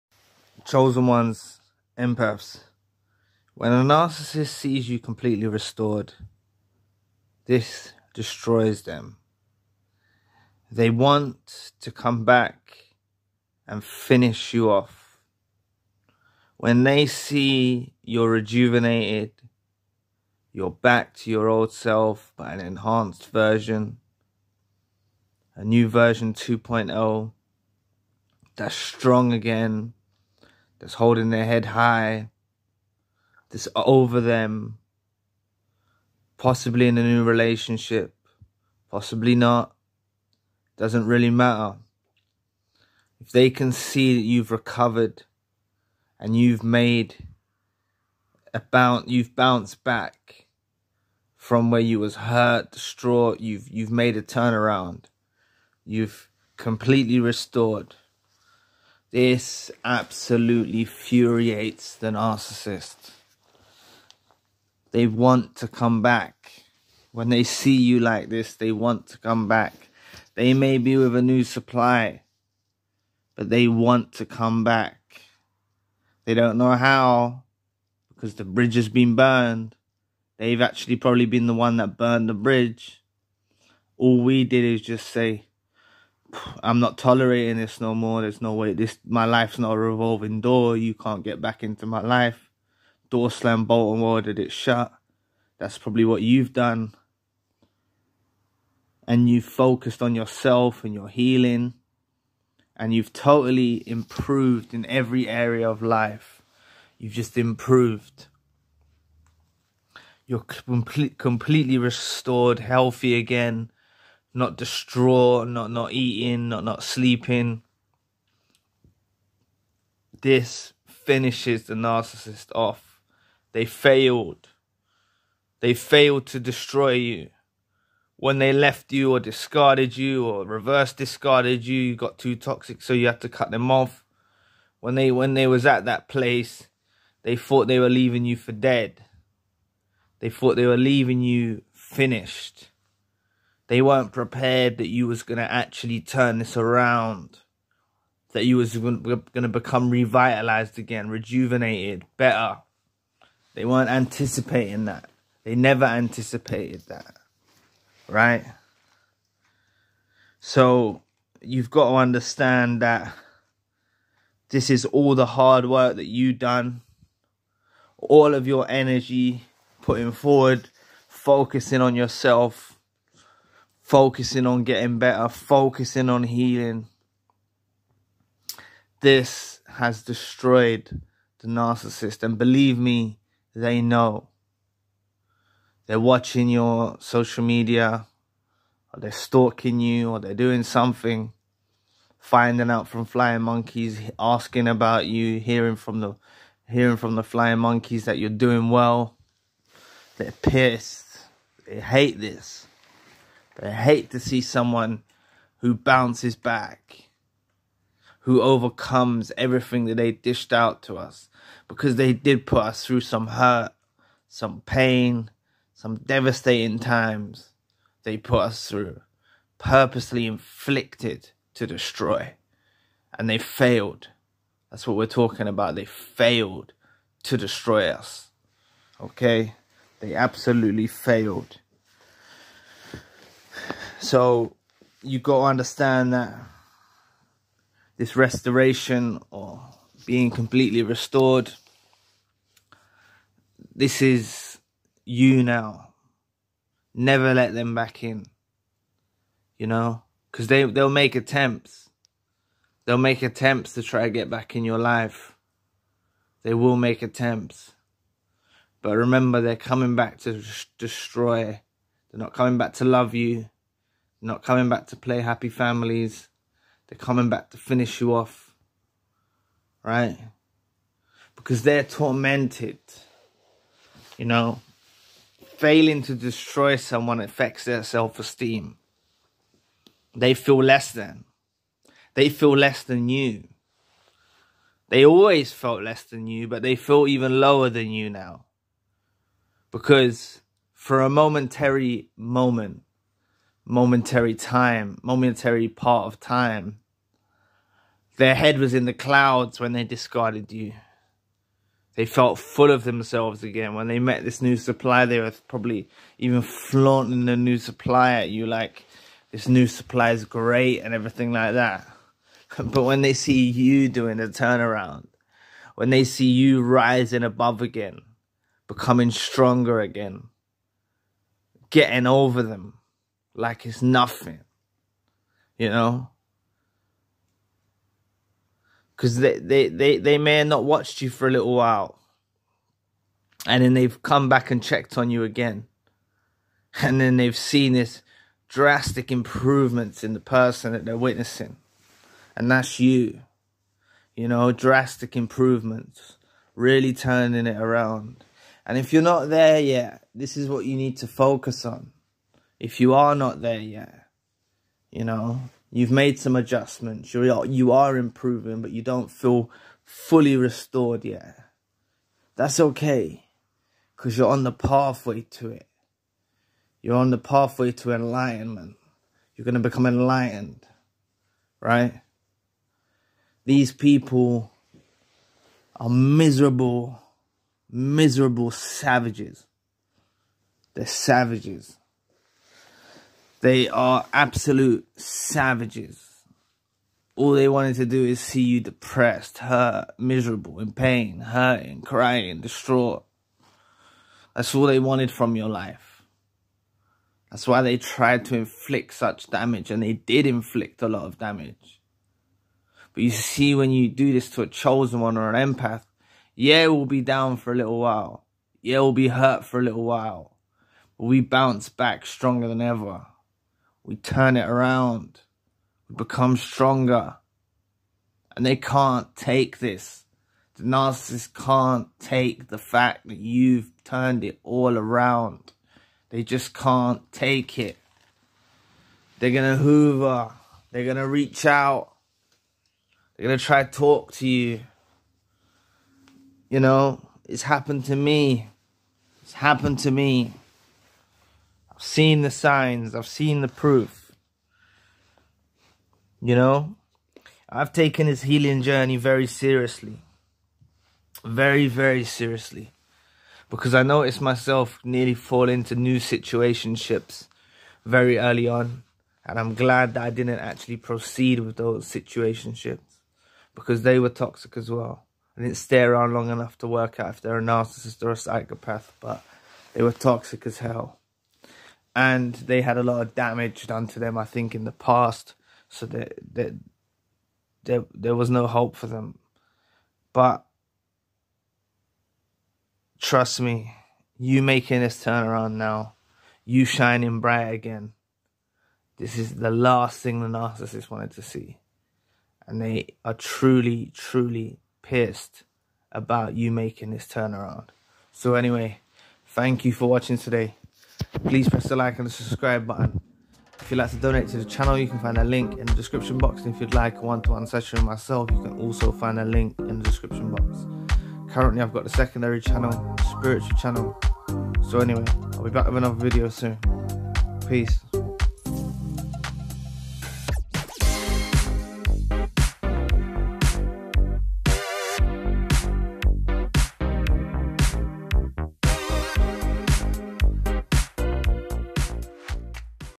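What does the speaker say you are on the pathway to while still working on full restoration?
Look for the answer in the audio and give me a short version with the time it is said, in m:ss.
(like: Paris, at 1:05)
enlightenment, at 6:07.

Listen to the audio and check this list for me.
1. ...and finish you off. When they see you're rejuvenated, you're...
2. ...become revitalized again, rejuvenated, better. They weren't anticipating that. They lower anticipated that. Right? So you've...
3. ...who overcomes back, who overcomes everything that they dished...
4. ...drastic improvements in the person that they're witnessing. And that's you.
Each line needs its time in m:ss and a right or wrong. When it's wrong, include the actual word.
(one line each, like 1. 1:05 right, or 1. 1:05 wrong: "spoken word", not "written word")
1. 0:13 right
2. 2:29 wrong: "never", not "lower"
3. 3:25 wrong: "bounces", not "overcomes"
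4. 5:38 right.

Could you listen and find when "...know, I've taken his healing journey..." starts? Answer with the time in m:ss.
7:26.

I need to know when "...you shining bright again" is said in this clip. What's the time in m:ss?
8:06.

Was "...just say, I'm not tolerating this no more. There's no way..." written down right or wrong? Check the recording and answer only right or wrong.
right.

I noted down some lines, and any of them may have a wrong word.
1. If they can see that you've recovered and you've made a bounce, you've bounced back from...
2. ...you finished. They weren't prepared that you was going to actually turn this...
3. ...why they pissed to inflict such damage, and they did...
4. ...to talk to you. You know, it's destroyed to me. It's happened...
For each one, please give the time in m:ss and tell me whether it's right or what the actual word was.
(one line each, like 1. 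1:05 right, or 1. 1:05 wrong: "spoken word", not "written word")
1. 0:43 right
2. 2:21 right
3. 6:37 wrong: "tried", not "pissed"
4. 7:13 wrong: "happened", not "destroyed".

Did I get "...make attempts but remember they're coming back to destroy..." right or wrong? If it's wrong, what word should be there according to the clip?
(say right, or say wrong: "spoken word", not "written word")
right.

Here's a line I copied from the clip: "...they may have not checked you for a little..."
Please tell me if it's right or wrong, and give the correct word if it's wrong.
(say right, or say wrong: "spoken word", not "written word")
wrong: "watched", not "checked".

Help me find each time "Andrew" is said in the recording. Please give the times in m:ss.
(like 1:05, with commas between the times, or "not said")
not said.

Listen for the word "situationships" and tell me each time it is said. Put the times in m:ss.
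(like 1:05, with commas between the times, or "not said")
7:35, 7:41.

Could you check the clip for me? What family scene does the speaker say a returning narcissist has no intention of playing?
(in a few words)
happy families.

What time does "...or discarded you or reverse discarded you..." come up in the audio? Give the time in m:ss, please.
2:09.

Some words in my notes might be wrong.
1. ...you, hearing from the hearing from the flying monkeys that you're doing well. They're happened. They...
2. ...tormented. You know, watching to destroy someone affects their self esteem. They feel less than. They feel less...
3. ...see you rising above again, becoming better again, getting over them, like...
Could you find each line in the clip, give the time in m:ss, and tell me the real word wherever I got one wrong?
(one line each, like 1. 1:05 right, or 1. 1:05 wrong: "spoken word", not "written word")
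1. 3:15 wrong: "pissed", not "happened"
2. 4:31 wrong: "failing", not "watching"
3. 5:16 wrong: "stronger", not "better".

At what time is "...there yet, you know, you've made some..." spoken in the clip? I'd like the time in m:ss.
5:53.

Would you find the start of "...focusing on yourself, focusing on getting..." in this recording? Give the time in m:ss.
2:51.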